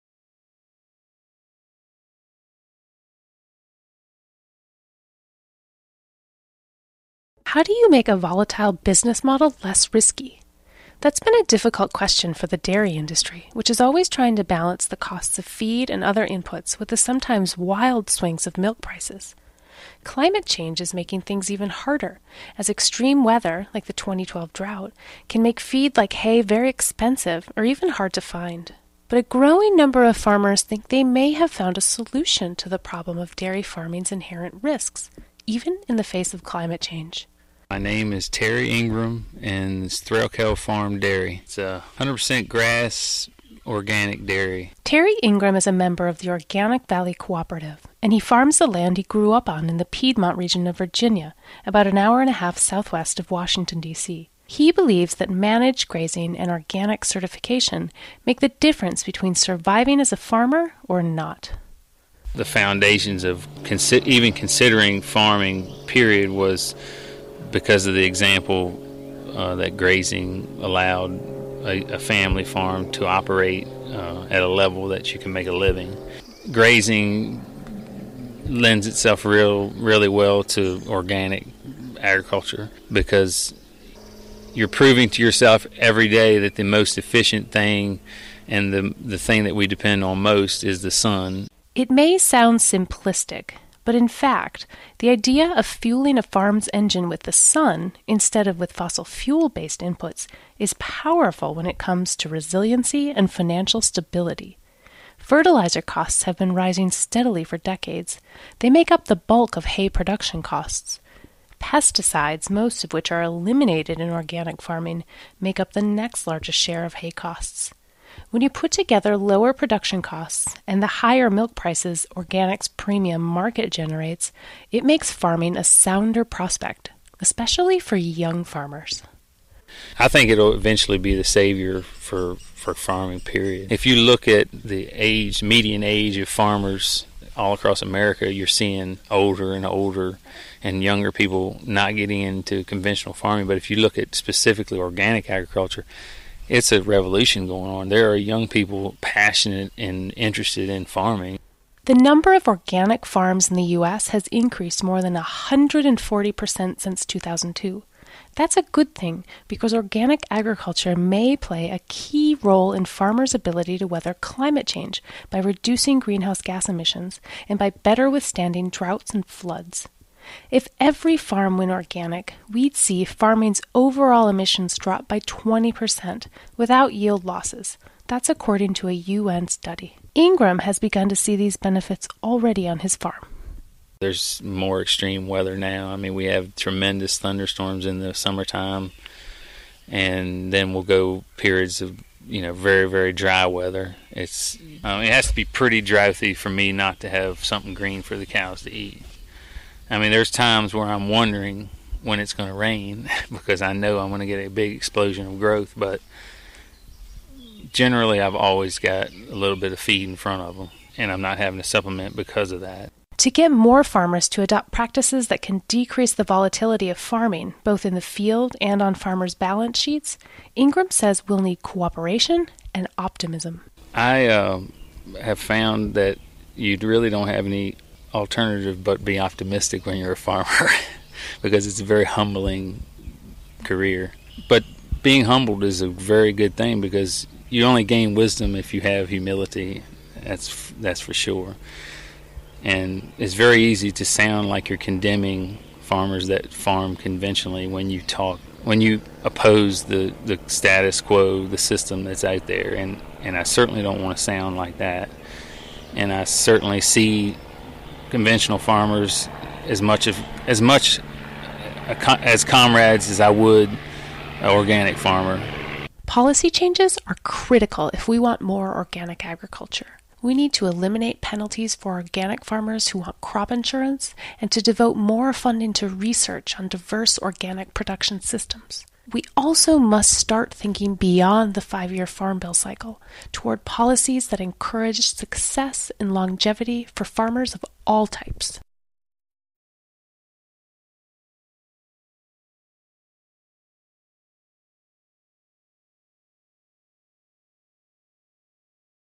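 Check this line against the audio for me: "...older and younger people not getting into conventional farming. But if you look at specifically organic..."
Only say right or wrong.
right.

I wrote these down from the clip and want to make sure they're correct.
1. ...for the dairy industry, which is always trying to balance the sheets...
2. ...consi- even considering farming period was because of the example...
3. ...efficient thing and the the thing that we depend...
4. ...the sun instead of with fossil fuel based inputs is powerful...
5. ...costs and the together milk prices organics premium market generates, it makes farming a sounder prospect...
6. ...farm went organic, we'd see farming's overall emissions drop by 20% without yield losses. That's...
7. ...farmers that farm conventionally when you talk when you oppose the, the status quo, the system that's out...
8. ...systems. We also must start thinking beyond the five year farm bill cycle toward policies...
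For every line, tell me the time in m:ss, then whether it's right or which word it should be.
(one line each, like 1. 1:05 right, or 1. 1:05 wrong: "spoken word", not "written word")
1. 0:12 wrong: "costs", not "sheets"
2. 1:03 right
3. 1:26 right
4. 1:37 right
5. 2:00 wrong: "higher", not "together"
6. 2:51 right
7. 4:05 right
8. 4:38 right.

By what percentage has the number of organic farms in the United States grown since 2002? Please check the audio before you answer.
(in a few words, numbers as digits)
140%.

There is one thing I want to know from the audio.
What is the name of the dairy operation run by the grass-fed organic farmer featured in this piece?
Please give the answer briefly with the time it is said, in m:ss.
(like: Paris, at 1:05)
Threlkeld Farm Dairy, at 0:40.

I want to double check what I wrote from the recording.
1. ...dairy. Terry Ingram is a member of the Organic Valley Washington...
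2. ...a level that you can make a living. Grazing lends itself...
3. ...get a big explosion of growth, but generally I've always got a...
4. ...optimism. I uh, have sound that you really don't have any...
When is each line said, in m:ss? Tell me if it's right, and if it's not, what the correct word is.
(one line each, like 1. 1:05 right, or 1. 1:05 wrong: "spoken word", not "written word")
1. 0:44 wrong: "Cooperative", not "Washington"
2. 1:14 right
3. 3:24 right
4. 3:42 wrong: "found", not "sound".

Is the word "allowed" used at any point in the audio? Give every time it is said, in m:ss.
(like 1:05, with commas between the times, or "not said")
1:10.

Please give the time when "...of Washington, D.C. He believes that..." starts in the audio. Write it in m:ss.
0:53.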